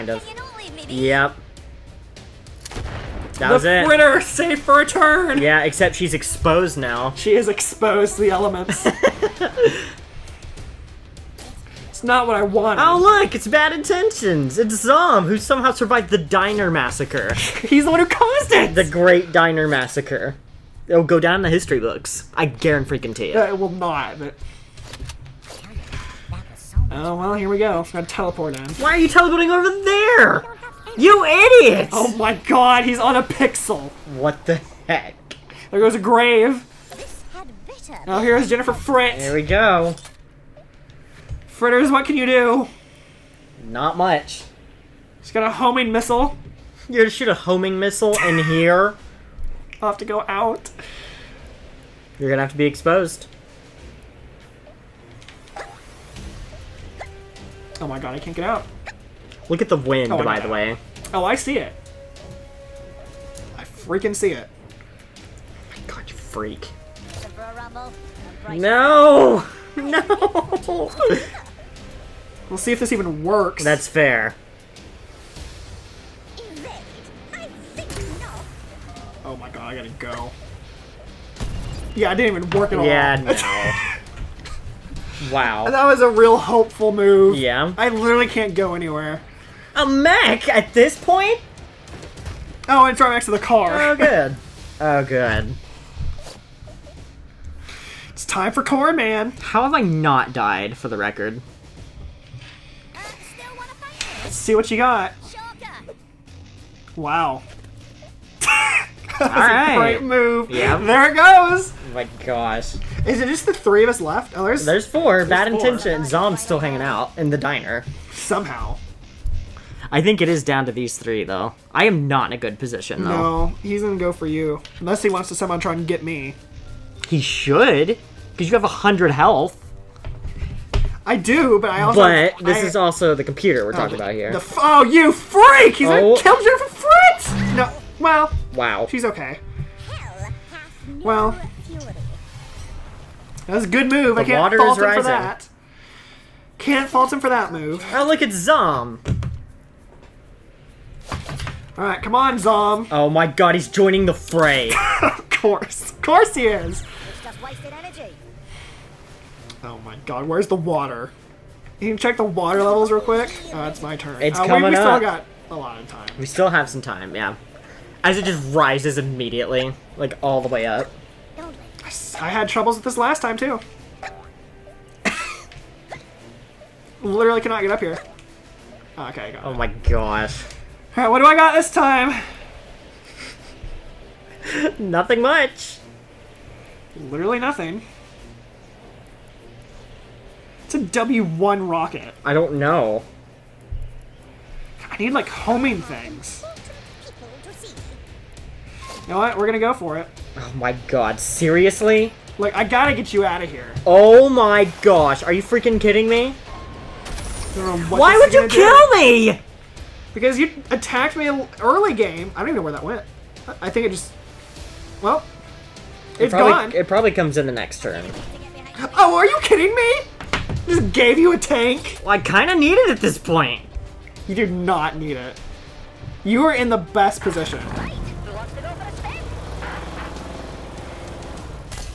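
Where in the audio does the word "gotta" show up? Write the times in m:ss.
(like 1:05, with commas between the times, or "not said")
0:27, 1:19, 3:22.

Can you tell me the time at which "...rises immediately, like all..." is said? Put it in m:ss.
2:48.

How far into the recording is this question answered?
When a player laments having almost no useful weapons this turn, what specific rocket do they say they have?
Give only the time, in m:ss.
3:10.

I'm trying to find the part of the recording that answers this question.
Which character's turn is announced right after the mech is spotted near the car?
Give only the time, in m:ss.
1:38.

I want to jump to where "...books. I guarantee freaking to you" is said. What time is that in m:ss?
0:21.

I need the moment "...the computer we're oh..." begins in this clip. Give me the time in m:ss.
2:13.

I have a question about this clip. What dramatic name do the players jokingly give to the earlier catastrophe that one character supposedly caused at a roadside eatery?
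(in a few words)
The Great Diner Massacre.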